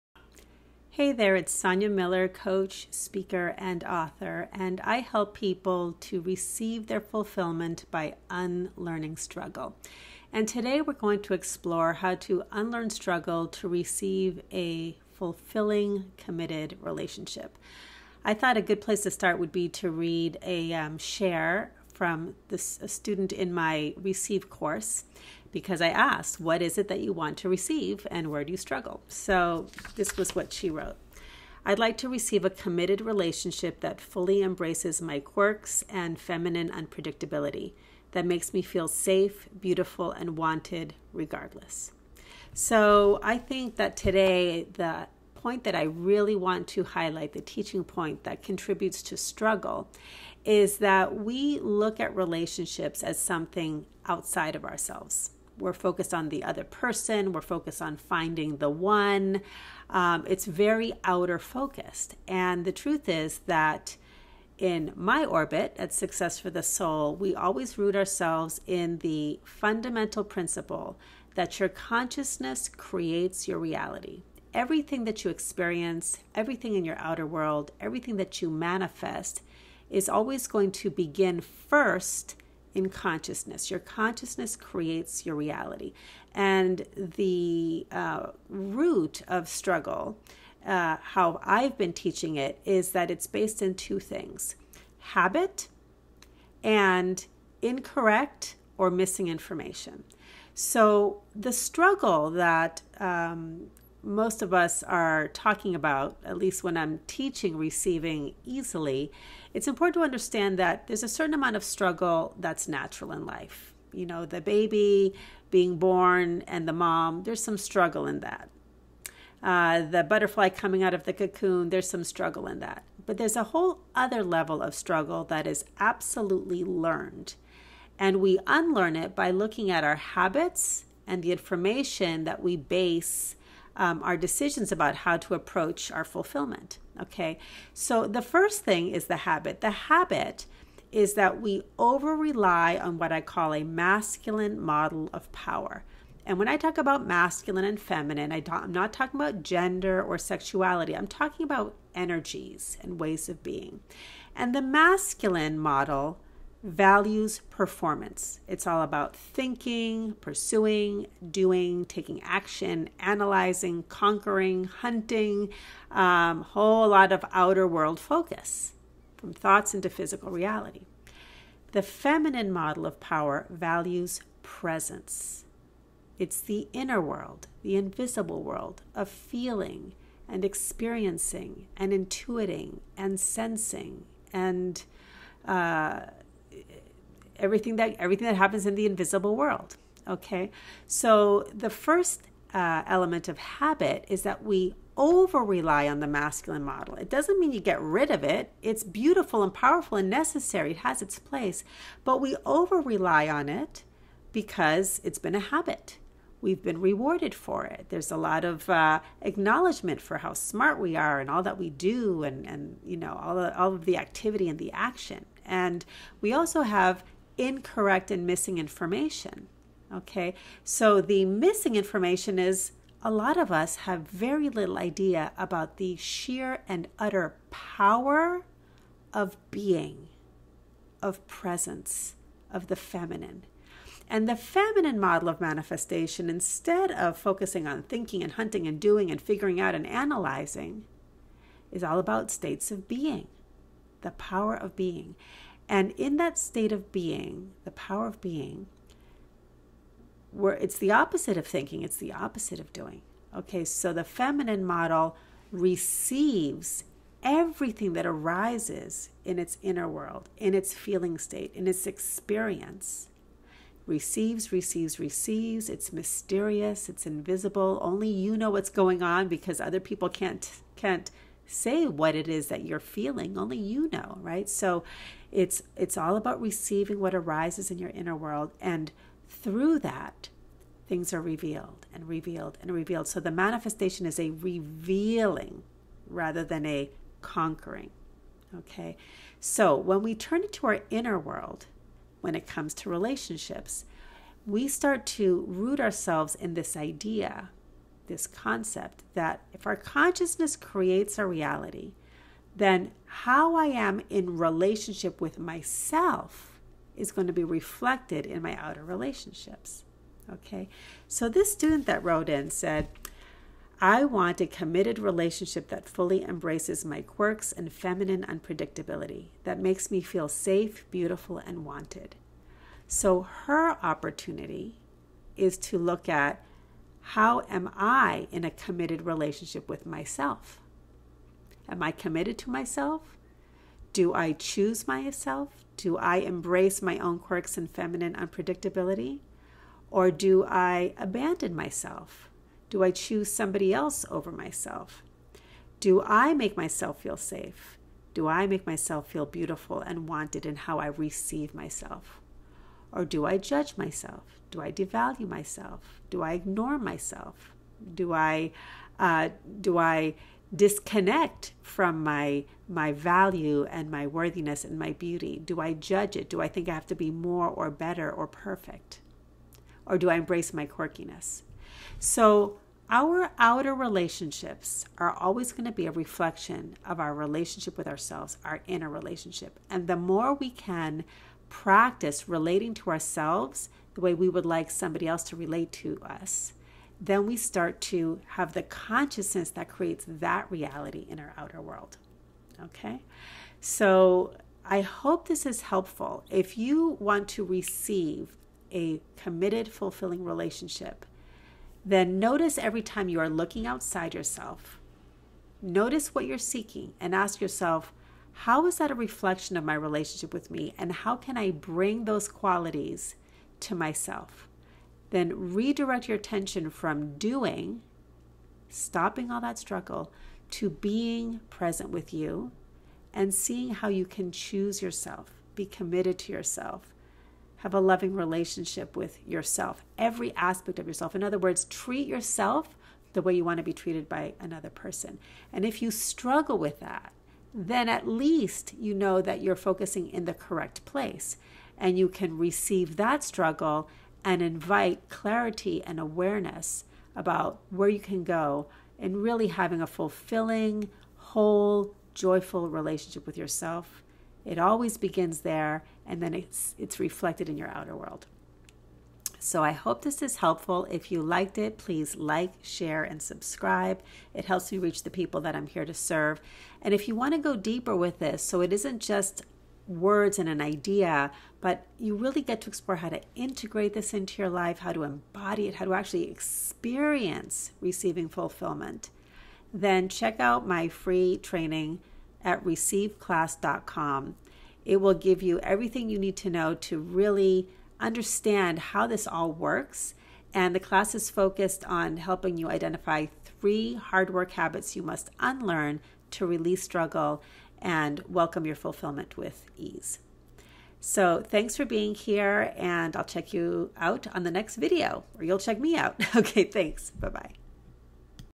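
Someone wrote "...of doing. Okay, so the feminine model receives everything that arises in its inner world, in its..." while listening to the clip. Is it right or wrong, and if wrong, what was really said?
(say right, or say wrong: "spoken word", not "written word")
right.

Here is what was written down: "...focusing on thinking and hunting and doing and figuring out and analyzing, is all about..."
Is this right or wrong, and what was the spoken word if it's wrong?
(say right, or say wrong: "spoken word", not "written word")
right.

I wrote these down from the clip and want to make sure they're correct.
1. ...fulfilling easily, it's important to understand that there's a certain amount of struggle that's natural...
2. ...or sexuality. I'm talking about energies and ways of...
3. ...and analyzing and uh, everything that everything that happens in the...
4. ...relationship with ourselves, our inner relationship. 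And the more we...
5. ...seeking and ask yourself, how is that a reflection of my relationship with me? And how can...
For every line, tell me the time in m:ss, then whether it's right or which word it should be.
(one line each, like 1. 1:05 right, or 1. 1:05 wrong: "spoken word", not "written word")
1. 1:47 wrong: "receiving", not "fulfilling"
2. 2:30 right
3. 3:02 wrong: "sensing", not "analyzing"
4. 6:17 right
5. 6:46 right.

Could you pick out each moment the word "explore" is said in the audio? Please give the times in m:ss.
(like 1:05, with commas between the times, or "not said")
0:11, 7:52.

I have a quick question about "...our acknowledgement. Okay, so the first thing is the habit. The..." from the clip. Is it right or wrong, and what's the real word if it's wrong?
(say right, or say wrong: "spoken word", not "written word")
wrong: "fulfillment", not "acknowledgement".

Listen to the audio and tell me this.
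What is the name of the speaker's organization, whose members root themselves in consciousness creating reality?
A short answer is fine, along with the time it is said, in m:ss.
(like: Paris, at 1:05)
Success for the Soul, at 1:05.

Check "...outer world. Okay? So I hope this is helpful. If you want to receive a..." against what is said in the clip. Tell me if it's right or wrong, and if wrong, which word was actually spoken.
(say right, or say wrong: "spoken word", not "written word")
right.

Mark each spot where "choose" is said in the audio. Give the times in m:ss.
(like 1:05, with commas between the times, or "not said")
5:34, 5:42, 7:04.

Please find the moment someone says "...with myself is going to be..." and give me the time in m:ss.
5:05.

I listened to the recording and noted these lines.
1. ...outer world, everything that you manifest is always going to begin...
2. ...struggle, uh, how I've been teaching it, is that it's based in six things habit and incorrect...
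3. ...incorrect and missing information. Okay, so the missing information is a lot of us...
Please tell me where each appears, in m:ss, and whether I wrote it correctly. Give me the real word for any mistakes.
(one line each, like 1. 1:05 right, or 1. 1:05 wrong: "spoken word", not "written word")
1. 1:16 right
2. 1:29 wrong: "two", not "six"
3. 3:37 right.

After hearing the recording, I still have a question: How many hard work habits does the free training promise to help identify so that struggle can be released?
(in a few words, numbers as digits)
3.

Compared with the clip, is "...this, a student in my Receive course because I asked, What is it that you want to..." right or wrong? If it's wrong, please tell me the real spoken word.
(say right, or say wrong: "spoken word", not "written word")
right.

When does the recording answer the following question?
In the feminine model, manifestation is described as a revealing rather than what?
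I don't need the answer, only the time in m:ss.
4:46.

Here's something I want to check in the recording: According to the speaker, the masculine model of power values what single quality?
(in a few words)
Performance.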